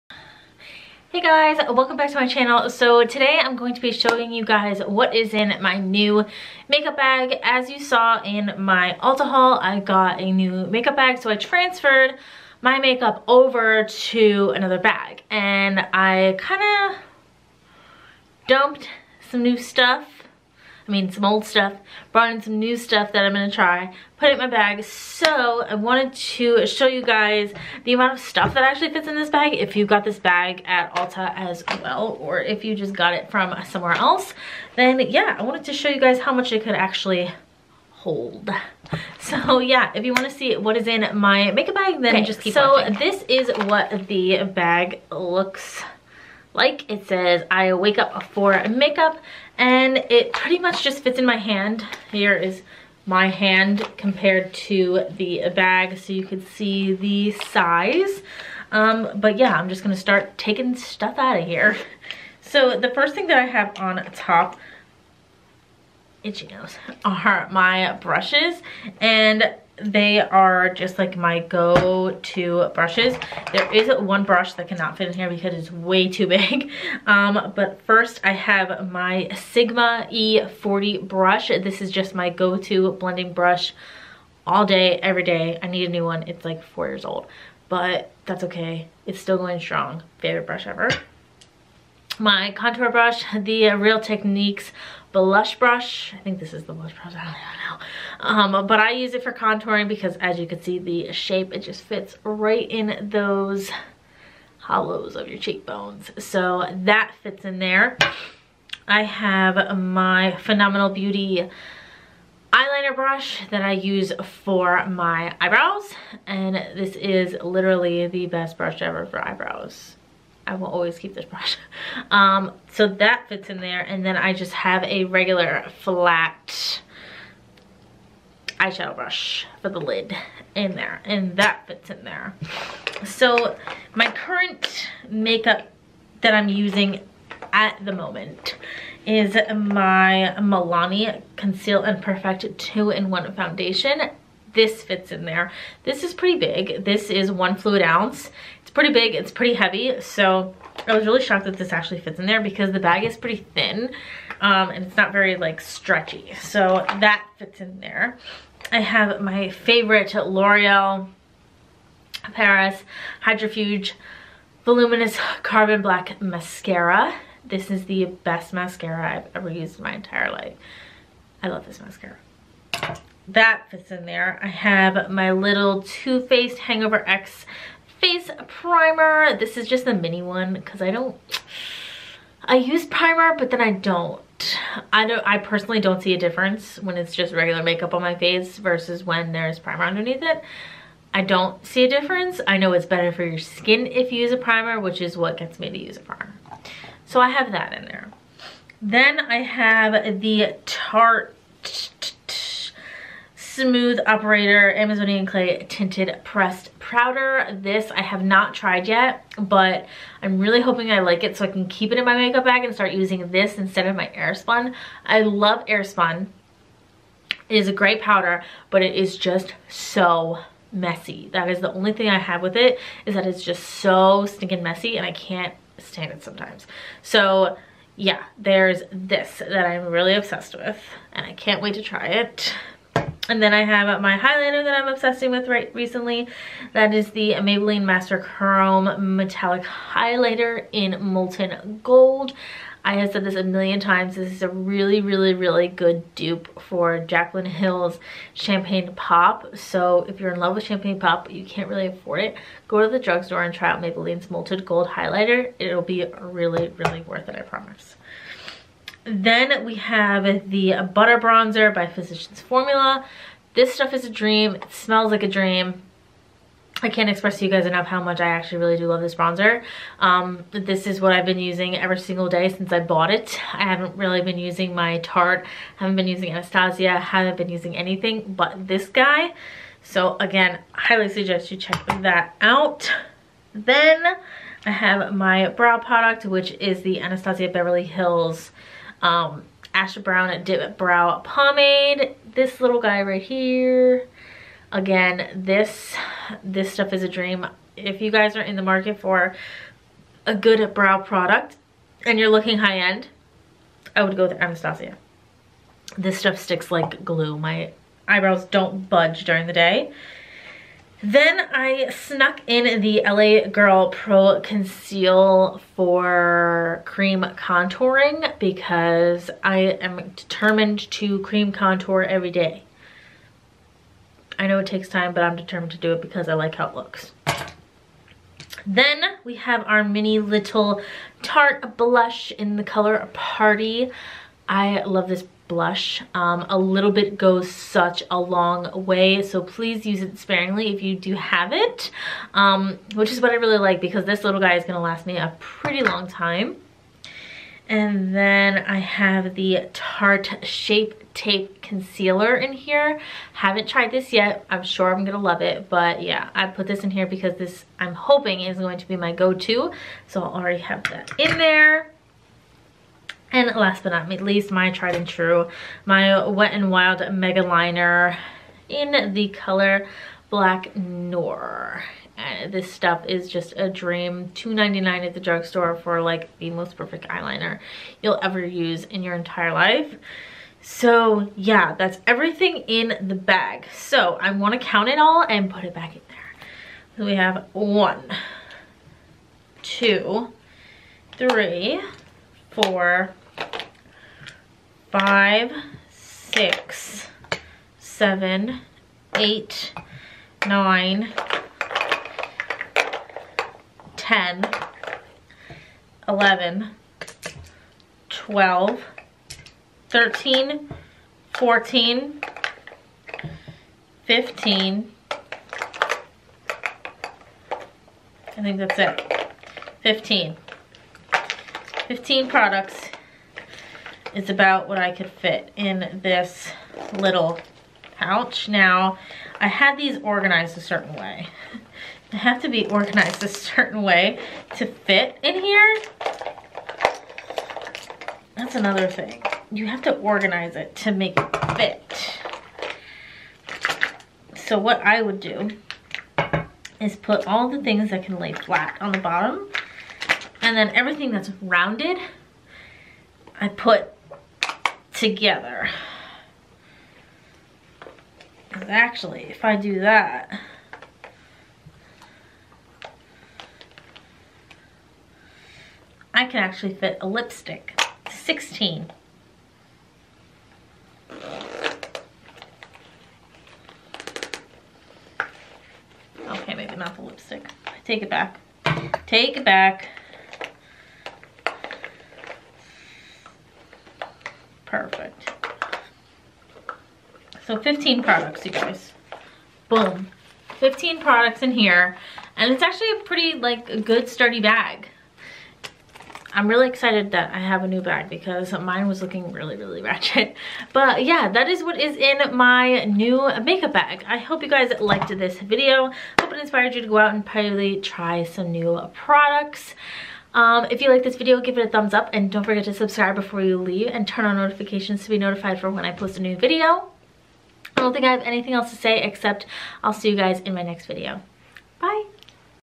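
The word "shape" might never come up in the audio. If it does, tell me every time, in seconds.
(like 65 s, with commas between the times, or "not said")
101 s, 350 s.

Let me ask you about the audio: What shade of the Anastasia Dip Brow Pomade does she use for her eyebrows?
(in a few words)
Asher Brown.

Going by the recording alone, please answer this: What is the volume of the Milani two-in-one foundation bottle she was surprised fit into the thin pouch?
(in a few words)
1 fluid ounce.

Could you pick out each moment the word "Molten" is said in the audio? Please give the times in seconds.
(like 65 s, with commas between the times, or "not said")
241 s, 254 s.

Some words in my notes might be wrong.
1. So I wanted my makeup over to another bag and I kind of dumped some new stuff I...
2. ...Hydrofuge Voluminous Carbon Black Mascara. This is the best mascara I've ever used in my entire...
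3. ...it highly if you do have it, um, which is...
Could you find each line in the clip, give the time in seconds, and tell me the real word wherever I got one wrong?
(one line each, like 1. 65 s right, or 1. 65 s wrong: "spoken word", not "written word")
1. 11 s wrong: "transferred", not "wanted"
2. 163 s right
3. 340 s wrong: "sparingly", not "highly".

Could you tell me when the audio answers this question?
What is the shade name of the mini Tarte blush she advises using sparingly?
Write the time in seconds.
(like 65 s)
333 s.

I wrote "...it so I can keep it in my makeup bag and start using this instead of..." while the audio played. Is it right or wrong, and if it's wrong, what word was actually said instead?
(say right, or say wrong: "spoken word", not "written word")
right.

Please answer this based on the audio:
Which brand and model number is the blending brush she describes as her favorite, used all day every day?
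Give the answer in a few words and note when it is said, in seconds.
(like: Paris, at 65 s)
Sigma E40, at 79 s.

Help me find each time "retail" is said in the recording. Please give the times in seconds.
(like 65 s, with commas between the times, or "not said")
not said.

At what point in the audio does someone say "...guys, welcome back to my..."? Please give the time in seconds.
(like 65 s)
1 s.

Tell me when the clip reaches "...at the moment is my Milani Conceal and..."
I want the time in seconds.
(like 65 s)
137 s.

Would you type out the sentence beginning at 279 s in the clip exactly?
So again, highly suggest you check that out.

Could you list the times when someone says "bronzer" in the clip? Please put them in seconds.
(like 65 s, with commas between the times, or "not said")
261 s, 269 s.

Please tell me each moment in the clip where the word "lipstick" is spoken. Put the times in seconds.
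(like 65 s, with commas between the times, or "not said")
467 s, 477 s.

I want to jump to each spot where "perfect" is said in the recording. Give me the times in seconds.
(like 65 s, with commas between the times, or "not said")
142 s, 376 s.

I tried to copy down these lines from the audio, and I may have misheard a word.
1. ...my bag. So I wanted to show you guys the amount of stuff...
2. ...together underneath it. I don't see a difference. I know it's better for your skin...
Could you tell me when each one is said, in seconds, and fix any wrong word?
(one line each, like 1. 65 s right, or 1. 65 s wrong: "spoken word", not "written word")
1. 24 s right
2. 189 s wrong: "primer", not "together".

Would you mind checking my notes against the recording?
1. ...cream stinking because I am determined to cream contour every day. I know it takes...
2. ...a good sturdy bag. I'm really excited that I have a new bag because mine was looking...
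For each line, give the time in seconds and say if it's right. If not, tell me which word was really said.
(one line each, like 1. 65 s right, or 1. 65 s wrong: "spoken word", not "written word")
1. 316 s wrong: "contouring", not "stinking"
2. 493 s right.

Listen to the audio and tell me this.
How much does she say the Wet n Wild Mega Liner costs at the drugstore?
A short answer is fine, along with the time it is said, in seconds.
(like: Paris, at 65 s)
$2.99, at 374 s.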